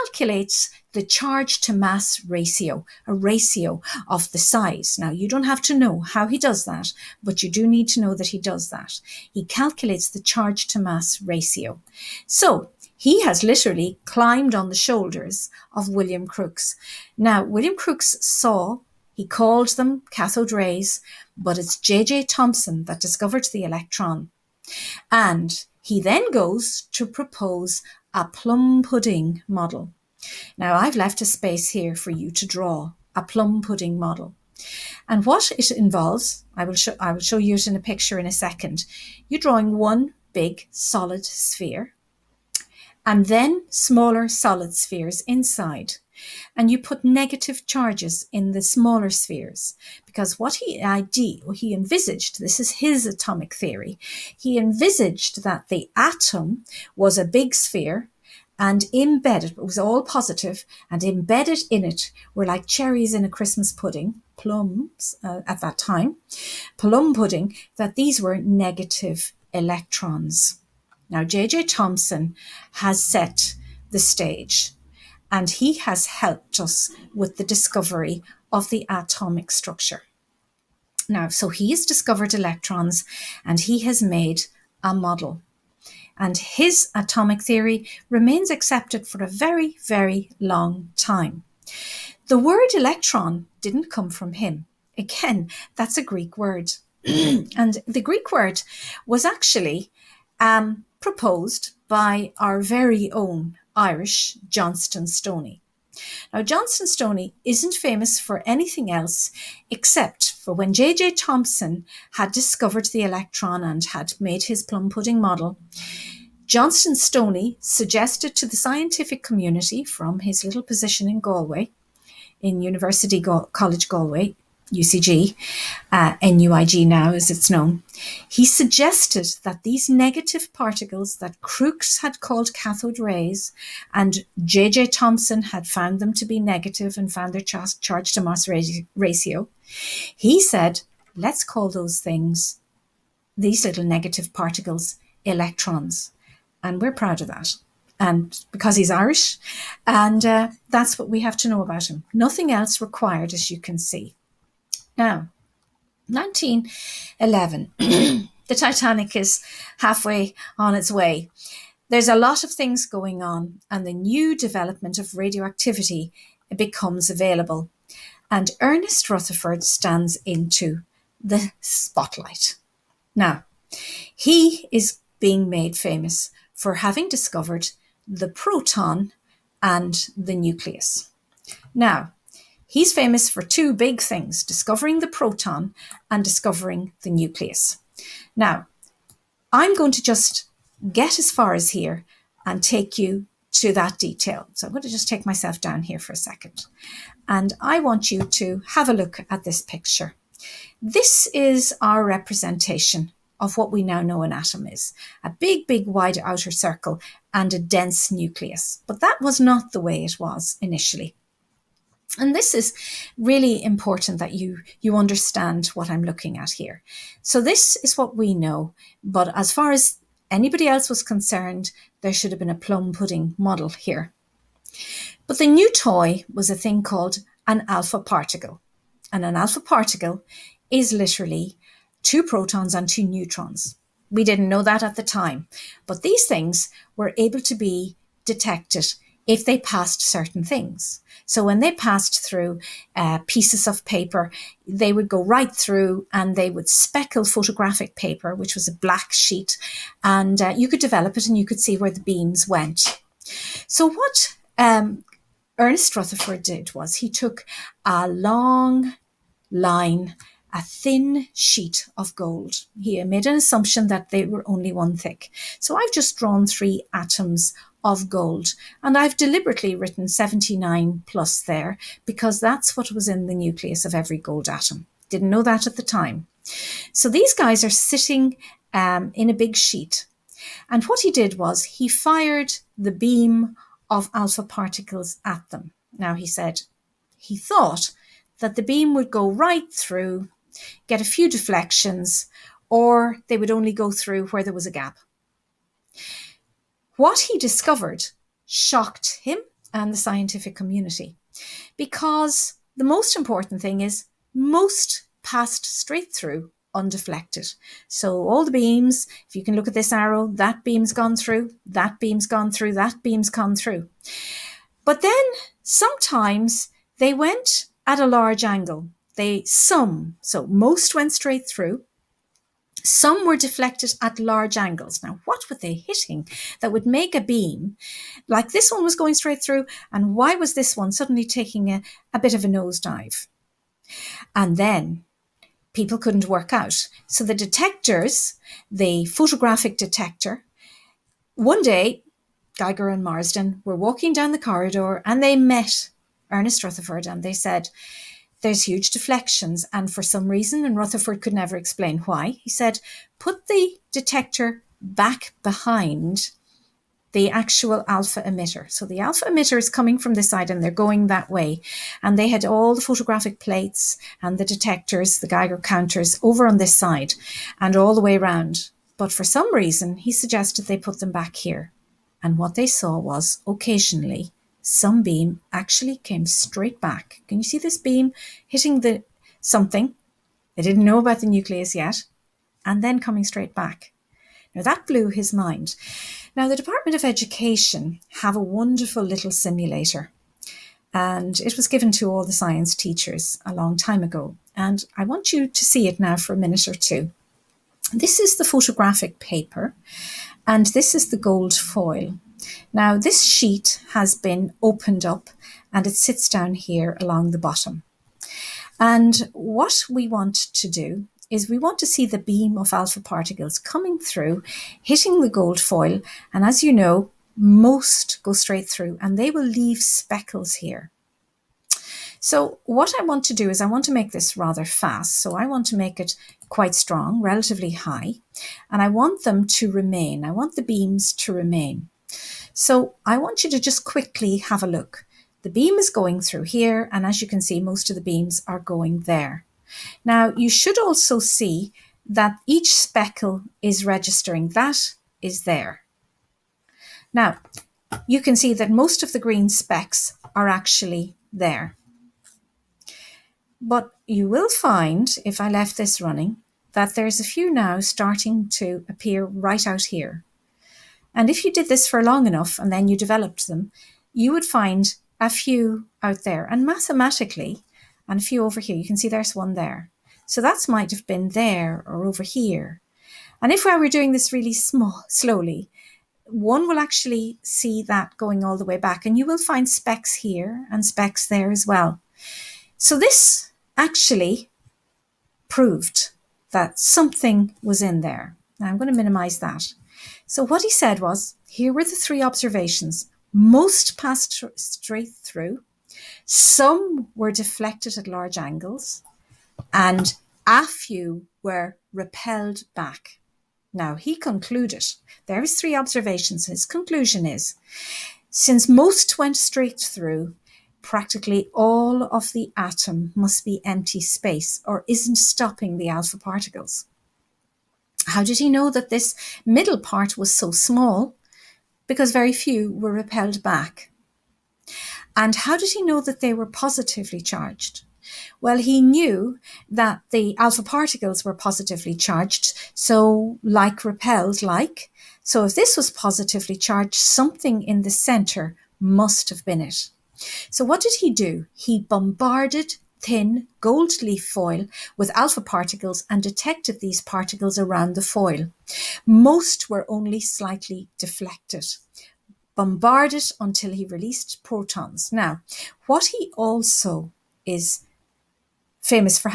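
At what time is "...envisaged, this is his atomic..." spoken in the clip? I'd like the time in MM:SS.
00:51.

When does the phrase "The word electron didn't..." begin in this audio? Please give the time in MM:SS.
01:32.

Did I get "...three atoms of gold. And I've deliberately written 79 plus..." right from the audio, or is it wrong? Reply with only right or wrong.
right.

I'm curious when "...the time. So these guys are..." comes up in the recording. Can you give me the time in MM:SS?
04:35.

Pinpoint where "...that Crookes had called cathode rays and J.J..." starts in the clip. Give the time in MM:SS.
02:11.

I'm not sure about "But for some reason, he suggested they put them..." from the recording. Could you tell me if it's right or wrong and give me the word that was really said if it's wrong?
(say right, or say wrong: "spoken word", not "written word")
right.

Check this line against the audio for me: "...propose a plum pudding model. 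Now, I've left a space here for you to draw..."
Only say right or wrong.
right.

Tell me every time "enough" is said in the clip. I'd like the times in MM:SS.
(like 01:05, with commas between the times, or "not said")
07:42.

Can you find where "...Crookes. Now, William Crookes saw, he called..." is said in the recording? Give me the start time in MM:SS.
00:16.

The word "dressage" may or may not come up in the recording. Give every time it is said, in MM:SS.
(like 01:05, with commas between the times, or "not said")
not said.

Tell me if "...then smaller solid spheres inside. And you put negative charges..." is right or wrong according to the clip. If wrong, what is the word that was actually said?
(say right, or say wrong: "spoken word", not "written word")
right.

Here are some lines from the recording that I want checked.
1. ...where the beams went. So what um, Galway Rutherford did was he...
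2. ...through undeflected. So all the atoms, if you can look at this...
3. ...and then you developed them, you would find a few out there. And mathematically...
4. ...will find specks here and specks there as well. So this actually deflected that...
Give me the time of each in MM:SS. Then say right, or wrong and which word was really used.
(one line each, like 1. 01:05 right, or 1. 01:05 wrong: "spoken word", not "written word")
1. 04:11 wrong: "Ernest", not "Galway"
2. 05:06 wrong: "beams", not "atoms"
3. 07:42 right
4. 07:59 wrong: "proved", not "deflected".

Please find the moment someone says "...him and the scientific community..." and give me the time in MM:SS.
04:59.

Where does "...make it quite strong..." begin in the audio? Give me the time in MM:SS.
07:05.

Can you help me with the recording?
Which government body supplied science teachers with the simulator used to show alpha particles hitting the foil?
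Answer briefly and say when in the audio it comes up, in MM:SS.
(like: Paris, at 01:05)
Department of Education, at 06:26.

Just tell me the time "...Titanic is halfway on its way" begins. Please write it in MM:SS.
02:38.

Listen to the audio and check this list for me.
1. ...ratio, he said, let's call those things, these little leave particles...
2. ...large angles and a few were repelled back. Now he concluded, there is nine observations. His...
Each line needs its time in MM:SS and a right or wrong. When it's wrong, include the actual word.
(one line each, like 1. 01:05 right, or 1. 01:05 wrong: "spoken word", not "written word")
1. 02:18 wrong: "negative", not "leave"
2. 08:18 wrong: "three", not "nine".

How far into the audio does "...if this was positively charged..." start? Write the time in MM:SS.
08:55.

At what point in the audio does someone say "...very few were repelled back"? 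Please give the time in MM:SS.
08:42.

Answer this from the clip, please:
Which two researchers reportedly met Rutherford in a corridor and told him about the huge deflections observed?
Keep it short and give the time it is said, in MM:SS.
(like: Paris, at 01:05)
Geiger and Marsden, at 05:42.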